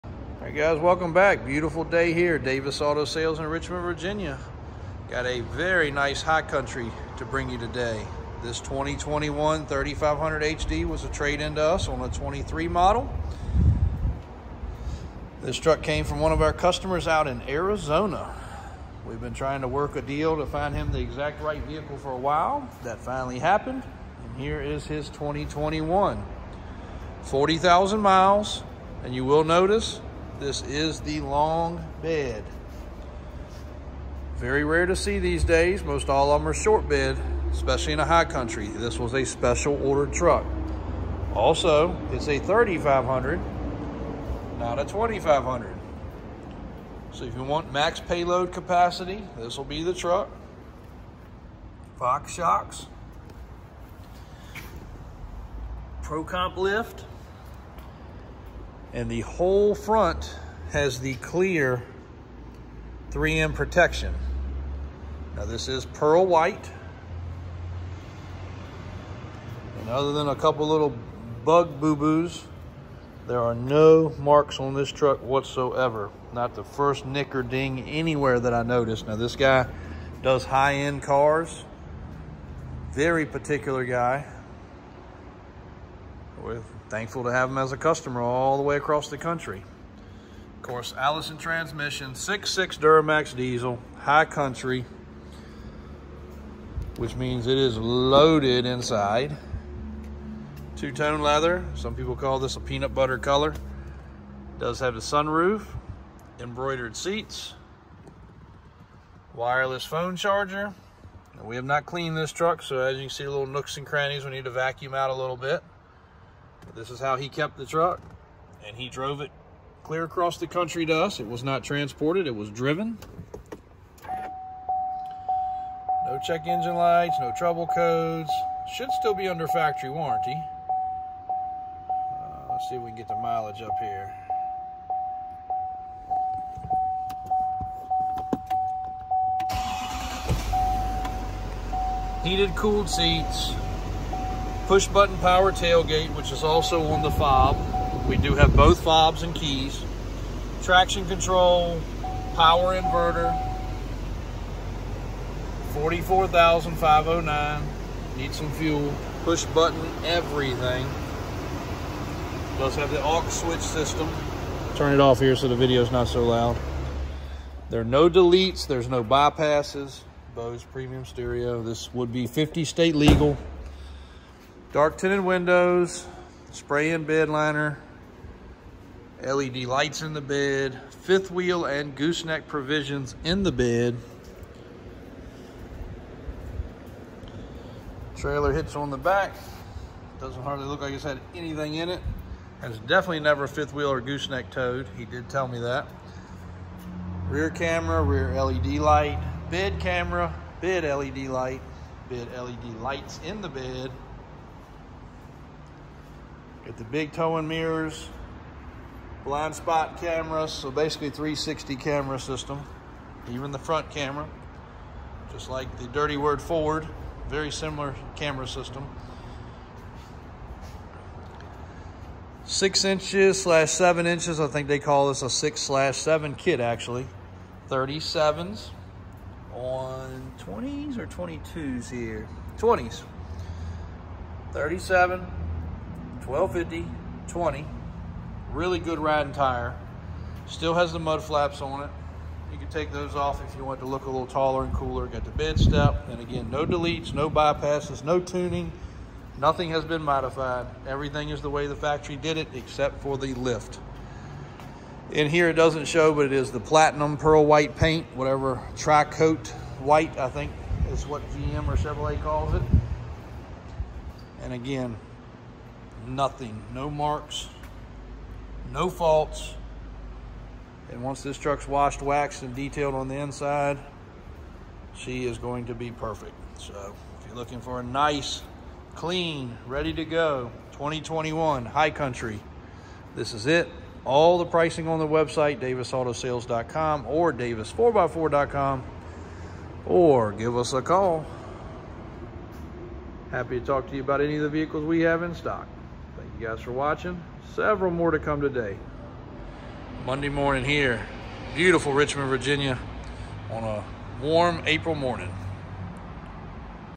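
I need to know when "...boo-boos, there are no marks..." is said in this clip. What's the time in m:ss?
1:11.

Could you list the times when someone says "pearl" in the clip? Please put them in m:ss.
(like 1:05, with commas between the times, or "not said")
1:05, 4:17.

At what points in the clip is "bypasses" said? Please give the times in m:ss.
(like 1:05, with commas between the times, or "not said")
2:49, 4:07.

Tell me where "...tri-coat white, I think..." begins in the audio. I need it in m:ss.
4:18.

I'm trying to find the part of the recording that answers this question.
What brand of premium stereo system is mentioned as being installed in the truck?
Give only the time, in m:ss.
2:50.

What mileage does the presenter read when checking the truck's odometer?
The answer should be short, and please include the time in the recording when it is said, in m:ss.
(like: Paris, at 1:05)
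44,509, at 2:35.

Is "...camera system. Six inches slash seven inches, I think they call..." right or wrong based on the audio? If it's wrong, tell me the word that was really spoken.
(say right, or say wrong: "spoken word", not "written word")
right.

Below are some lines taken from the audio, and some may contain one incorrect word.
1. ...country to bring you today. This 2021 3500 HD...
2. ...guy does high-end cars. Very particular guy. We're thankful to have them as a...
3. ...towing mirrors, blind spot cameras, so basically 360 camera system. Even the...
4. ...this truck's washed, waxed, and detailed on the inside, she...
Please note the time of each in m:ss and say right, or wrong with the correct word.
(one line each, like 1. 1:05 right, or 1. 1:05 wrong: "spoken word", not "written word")
1. 0:06 right
2. 1:19 right
3. 3:27 right
4. 4:31 right.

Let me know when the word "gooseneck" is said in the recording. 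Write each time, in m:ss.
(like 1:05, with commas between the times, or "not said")
3:01, 3:13.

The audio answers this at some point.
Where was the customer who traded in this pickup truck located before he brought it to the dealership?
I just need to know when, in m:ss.
0:17.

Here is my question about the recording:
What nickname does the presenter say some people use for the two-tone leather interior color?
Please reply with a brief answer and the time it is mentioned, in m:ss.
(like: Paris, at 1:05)
peanut butter, at 1:42.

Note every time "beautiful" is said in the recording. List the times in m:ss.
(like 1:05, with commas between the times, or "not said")
0:01, 5:01.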